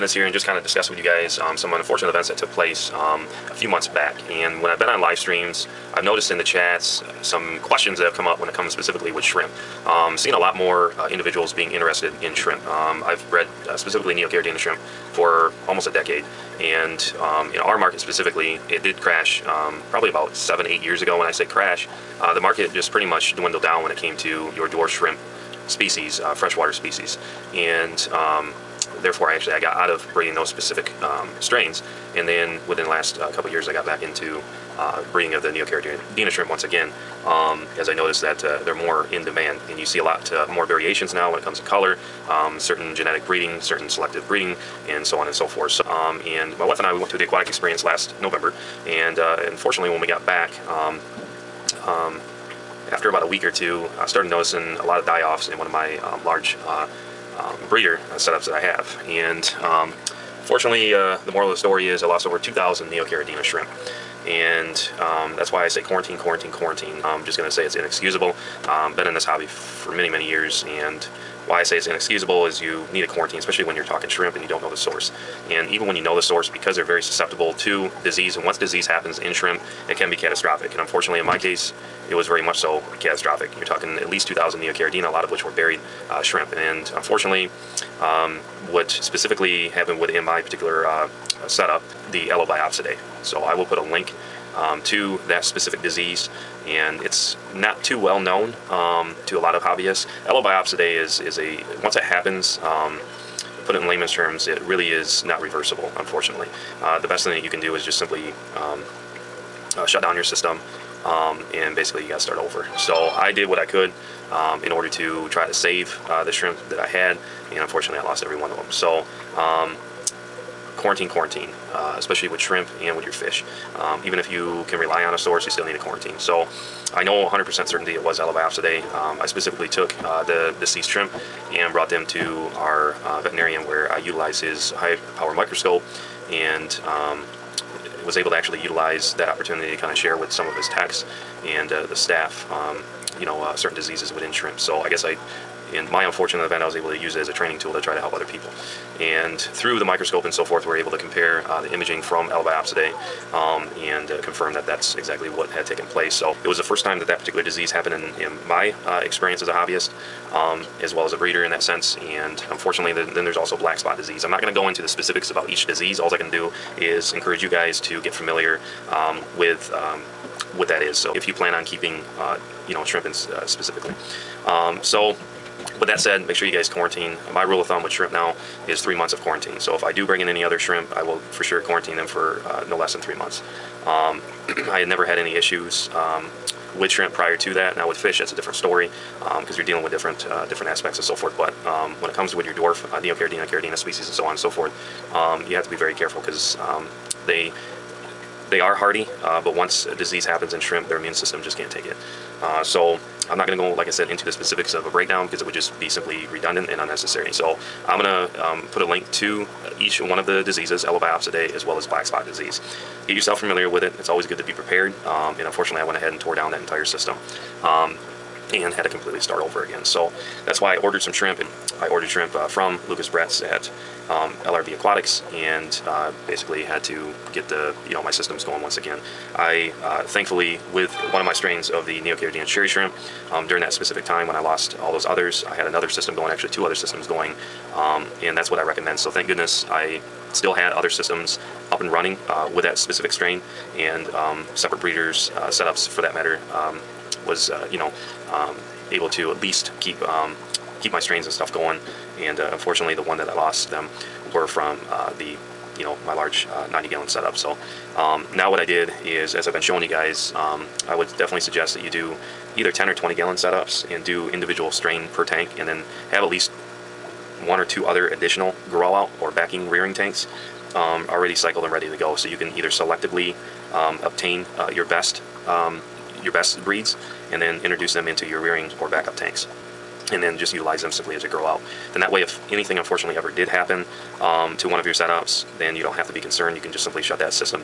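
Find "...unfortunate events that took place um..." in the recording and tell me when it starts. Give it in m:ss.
0:01.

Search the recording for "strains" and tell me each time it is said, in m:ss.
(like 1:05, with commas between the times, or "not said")
0:31, 3:51, 4:03, 4:10, 4:24.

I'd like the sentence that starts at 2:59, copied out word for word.
So if I do bring in any other shrimp, I will for sure quarantine them for uh, no less than three months.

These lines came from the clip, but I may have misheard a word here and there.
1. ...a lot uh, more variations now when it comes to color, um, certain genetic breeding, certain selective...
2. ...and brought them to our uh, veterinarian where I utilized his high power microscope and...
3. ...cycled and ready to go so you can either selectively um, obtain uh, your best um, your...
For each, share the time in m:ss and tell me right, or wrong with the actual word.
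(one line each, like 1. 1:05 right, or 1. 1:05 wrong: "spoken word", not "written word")
1. 0:39 right
2. 2:11 right
3. 4:31 right.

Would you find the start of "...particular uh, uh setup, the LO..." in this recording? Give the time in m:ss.
1:30.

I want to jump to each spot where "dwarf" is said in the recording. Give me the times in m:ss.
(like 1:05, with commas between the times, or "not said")
0:24, 3:12.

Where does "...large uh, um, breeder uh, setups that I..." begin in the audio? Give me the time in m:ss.
0:56.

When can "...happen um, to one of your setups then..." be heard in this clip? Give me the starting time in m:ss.
4:43.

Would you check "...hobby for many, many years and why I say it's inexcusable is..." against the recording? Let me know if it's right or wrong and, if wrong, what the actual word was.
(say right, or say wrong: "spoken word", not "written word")
right.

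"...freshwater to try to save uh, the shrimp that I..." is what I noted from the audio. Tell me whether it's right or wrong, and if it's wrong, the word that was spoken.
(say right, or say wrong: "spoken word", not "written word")
wrong: "order", not "freshwater".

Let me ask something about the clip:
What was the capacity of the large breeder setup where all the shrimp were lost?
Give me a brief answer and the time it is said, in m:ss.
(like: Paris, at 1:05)
90 gallons, at 4:16.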